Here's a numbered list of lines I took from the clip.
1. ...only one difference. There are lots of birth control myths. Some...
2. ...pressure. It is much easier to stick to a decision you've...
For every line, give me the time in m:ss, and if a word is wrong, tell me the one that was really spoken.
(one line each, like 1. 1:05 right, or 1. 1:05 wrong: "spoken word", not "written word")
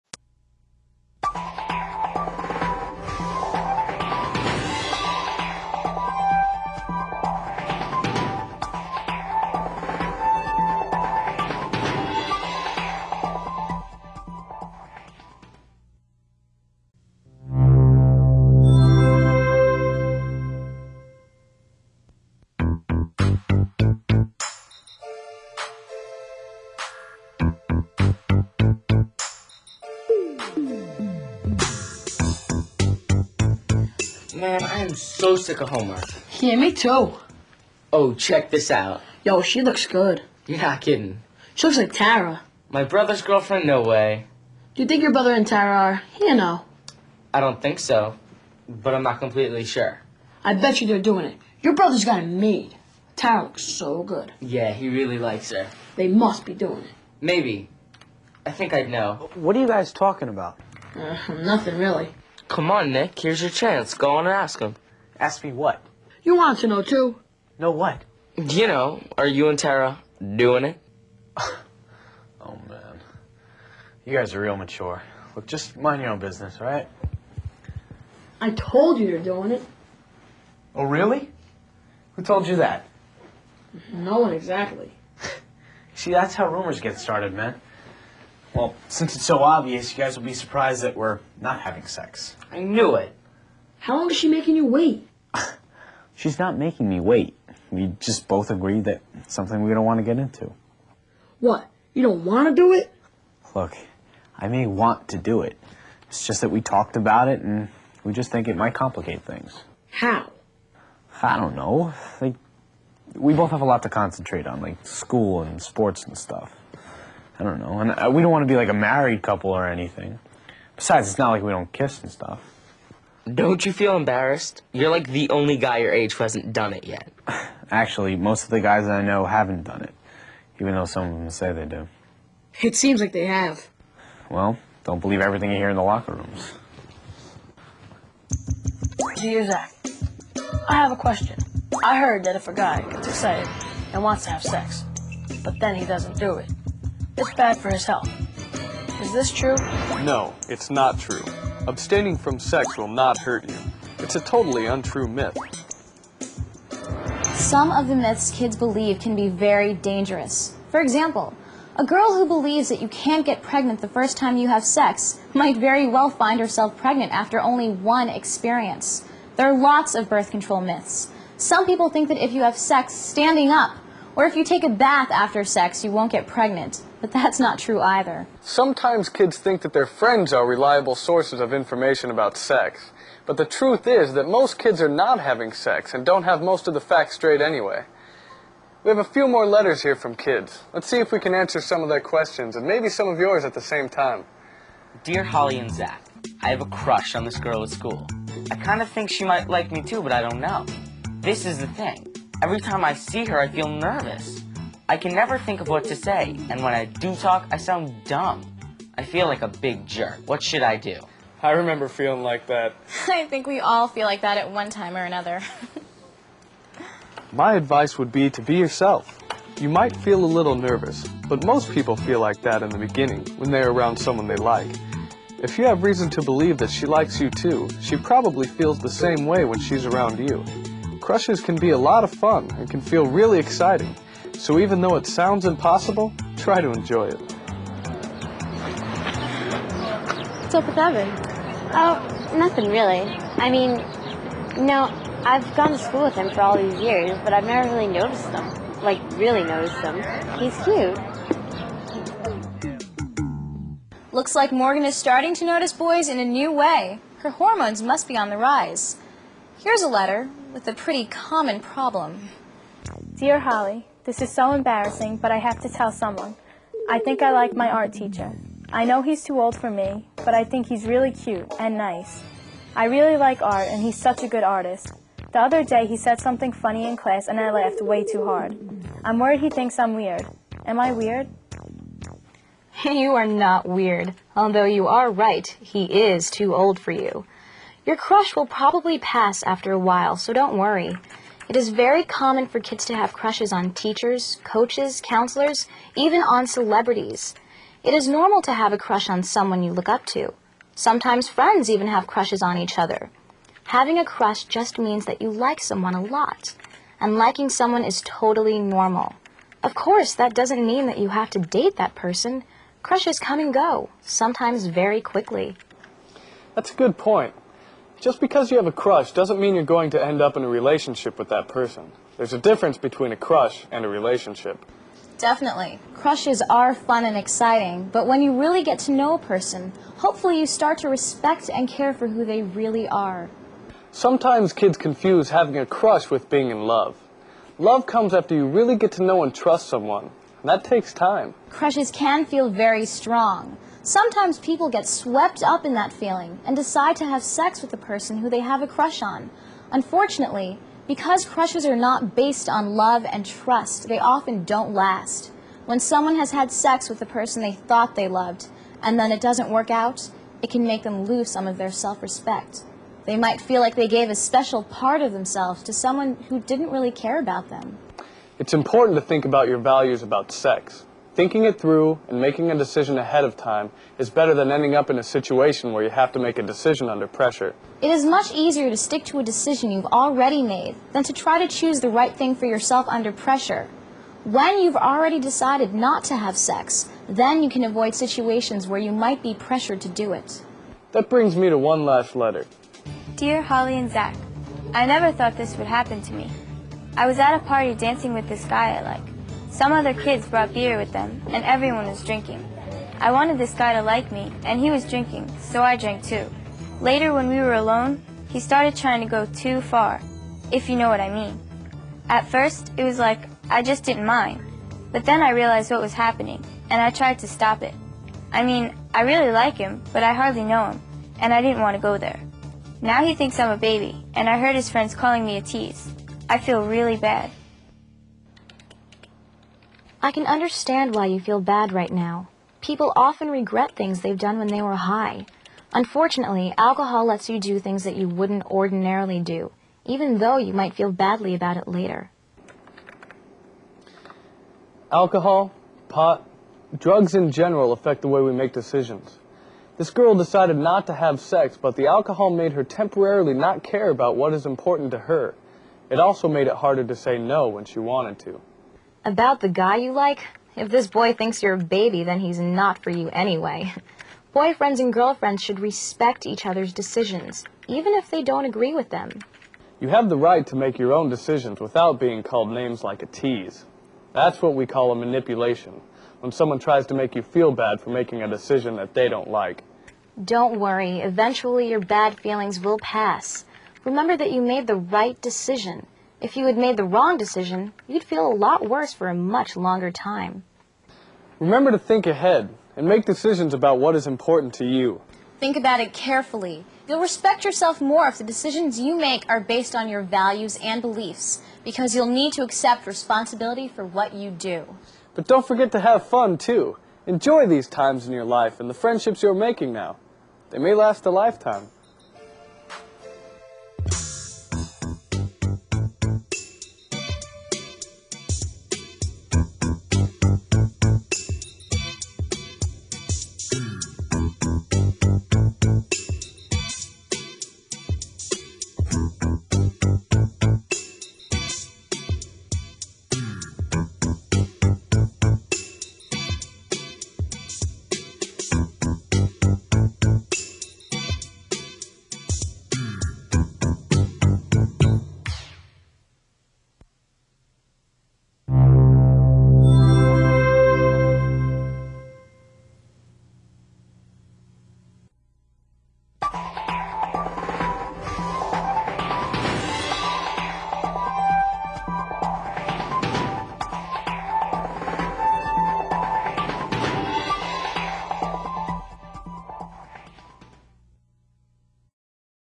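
1. 2:47 wrong: "experience", not "difference"
2. 6:17 right.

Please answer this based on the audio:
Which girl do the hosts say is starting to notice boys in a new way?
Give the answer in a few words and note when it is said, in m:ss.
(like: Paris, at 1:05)
Morgan, at 4:14.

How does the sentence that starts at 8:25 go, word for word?
But don't forget to have fun, too.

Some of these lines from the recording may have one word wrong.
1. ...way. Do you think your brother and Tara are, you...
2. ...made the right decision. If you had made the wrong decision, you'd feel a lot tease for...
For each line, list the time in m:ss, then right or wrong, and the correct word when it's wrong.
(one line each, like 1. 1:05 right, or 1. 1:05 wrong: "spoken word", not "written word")
1. 0:43 right
2. 8:04 wrong: "worse", not "tease".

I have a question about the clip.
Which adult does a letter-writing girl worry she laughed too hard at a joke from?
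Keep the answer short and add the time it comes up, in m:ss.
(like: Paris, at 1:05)
Art teacher, at 4:27.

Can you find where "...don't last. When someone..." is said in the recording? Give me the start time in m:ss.
5:54.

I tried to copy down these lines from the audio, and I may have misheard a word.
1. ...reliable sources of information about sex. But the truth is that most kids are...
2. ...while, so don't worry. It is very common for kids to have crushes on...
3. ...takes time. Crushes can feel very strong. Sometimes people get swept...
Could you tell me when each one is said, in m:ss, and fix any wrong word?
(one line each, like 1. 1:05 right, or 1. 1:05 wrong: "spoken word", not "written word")
1. 3:00 right
2. 4:49 right
3. 5:40 right.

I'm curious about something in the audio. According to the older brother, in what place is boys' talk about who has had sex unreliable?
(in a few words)
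Locker rooms.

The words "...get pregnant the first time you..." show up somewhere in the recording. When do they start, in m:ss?
2:43.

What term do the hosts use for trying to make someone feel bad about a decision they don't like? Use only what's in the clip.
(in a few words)
Manipulation.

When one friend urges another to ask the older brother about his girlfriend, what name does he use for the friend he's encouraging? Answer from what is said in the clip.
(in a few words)
Nick.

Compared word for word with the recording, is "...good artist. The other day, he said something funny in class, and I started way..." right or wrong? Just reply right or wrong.
wrong.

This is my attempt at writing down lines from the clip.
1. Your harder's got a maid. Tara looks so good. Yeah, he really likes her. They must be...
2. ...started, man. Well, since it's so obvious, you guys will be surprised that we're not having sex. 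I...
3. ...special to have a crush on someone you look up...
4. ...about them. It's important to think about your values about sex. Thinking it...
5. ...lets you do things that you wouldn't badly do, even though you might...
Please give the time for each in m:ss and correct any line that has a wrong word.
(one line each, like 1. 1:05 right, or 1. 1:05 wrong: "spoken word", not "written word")
1. 0:51 wrong: "brother", not "harder"
2. 1:26 right
3. 4:58 wrong: "normal", not "special"
4. 6:07 right
5. 7:17 wrong: "ordinarily", not "badly".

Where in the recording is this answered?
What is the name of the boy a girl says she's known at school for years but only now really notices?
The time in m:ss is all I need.
4:00.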